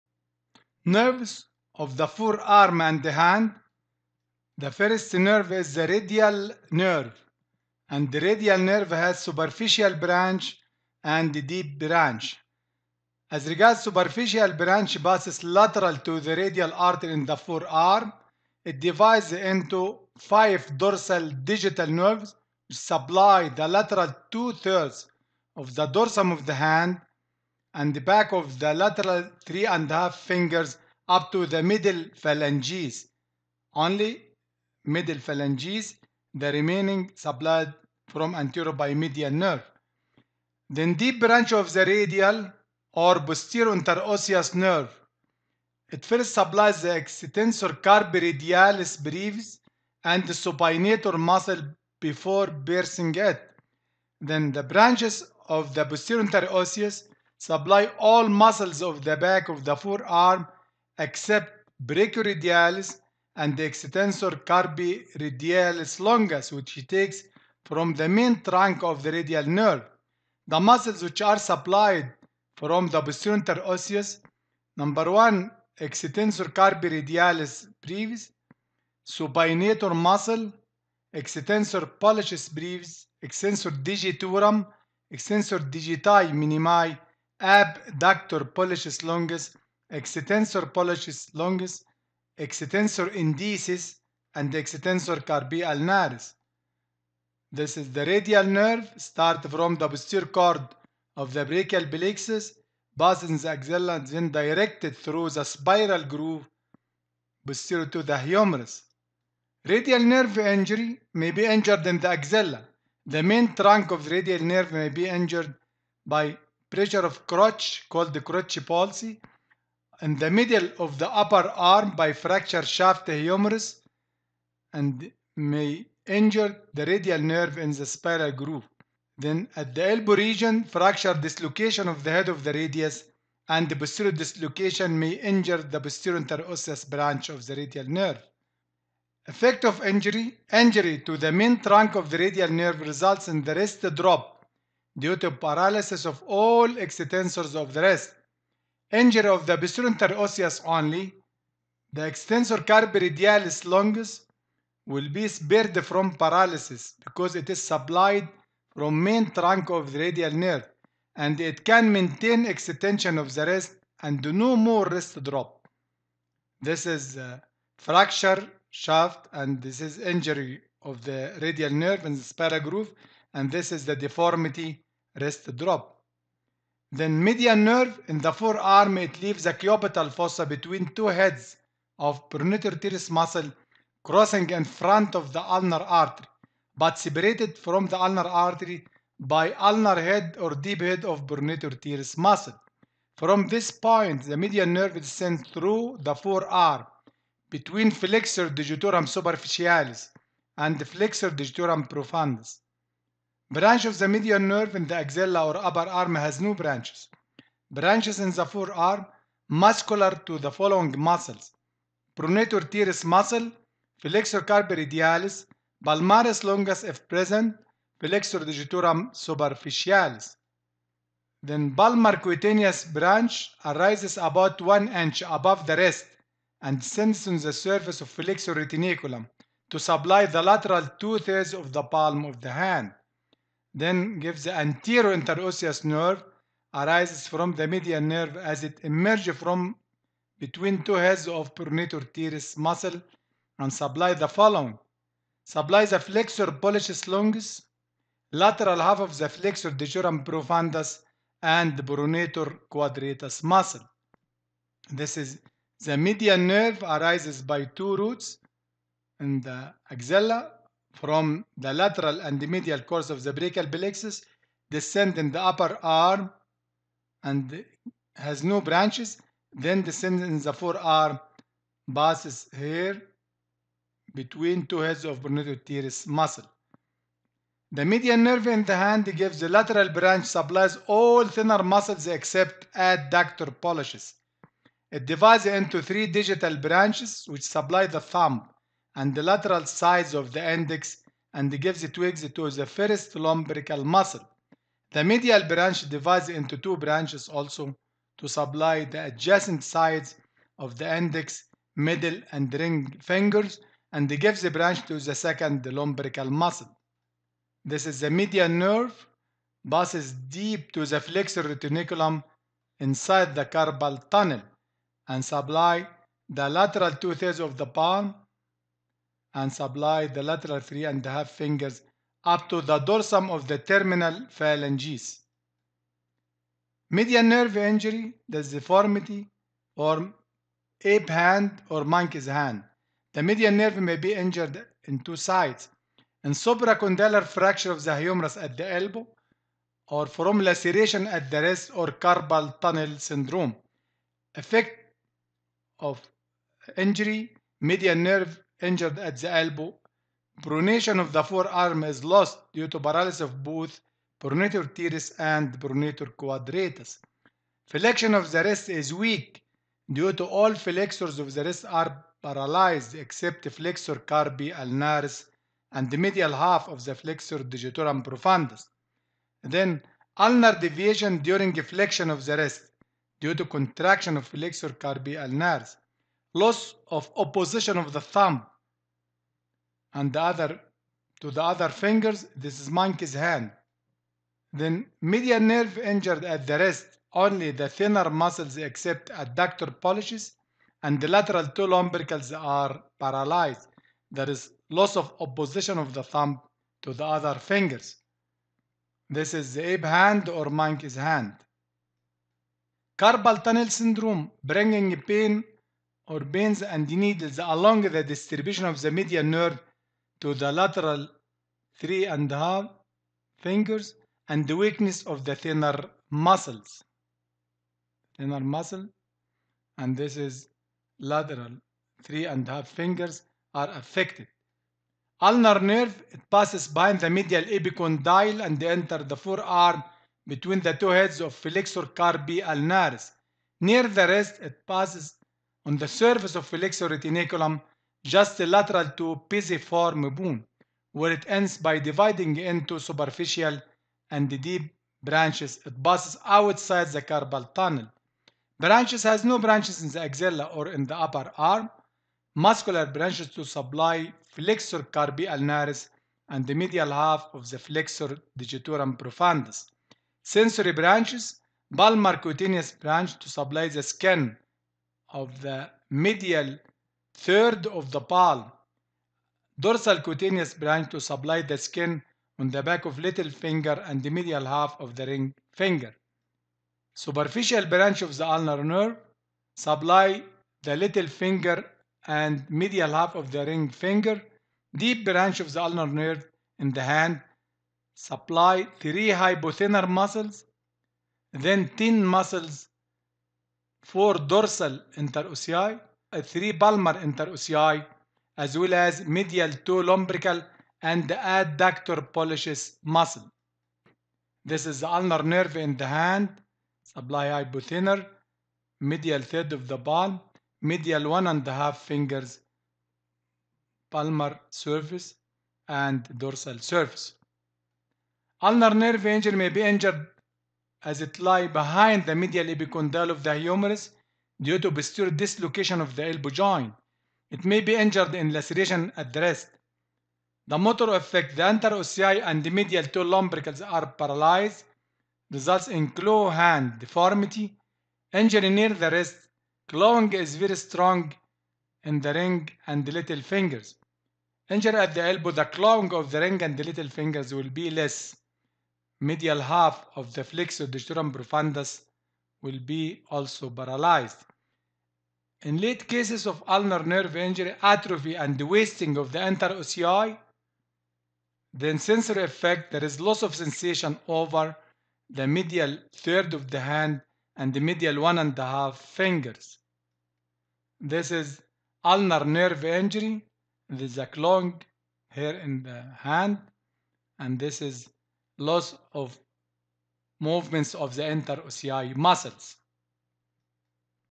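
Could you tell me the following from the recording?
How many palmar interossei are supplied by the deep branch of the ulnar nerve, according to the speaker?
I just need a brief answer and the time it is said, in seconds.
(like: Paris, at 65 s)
3, at 496 s.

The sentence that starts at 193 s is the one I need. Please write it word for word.
From this point, the median nerve is sent through the forearm between flexor digitorum superficialis and flexor digitorum profundus.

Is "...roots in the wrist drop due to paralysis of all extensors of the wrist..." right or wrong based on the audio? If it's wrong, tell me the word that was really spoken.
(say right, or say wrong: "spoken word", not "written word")
wrong: "results", not "roots".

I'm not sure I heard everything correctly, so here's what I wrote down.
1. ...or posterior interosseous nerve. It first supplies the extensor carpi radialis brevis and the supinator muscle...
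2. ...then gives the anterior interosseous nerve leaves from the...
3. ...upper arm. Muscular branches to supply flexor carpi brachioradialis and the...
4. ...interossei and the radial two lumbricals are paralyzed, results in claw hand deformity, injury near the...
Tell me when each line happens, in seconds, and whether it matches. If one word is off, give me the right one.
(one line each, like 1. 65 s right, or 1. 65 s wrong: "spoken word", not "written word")
1. 42 s right
2. 233 s wrong: "arises", not "leaves"
3. 450 s wrong: "ulnaris", not "brachioradialis"
4. 531 s wrong: "medial", not "radial".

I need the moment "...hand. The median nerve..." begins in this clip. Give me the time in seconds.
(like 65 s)
332 s.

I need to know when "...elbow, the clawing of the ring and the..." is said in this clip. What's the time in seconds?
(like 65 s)
545 s.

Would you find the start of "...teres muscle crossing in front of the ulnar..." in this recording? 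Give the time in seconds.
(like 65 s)
182 s.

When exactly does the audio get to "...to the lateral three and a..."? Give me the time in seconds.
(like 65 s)
410 s.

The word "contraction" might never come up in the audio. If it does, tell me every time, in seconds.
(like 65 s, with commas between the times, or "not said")
373 s.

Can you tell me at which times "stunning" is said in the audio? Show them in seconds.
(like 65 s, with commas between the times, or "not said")
not said.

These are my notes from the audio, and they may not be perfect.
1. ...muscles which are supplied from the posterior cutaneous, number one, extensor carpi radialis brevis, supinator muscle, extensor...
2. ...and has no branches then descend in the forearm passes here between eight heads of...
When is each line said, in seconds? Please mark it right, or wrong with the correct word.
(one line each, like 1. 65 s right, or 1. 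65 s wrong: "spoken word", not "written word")
1. 70 s wrong: "osseous", not "cutaneous"
2. 267 s wrong: "two", not "eight".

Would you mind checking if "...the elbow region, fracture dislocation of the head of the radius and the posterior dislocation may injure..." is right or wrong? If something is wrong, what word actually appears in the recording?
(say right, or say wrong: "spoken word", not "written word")
right.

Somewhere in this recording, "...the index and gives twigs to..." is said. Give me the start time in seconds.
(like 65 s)
290 s.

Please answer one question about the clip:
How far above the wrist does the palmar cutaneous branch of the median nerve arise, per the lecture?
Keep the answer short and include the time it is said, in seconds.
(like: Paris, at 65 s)
1 inch, at 224 s.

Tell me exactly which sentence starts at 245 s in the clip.
Supply the flexor pollicis longus, lateral half of the flexor digitorum profundus and pronator quadratus muscle.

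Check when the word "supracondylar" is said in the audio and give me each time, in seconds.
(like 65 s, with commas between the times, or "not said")
336 s.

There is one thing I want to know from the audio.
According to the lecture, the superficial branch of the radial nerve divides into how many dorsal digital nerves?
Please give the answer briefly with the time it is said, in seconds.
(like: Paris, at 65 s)
5, at 20 s.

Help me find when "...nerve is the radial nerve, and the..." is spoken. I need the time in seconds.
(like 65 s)
5 s.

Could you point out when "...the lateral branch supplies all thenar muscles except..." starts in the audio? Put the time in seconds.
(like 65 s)
279 s.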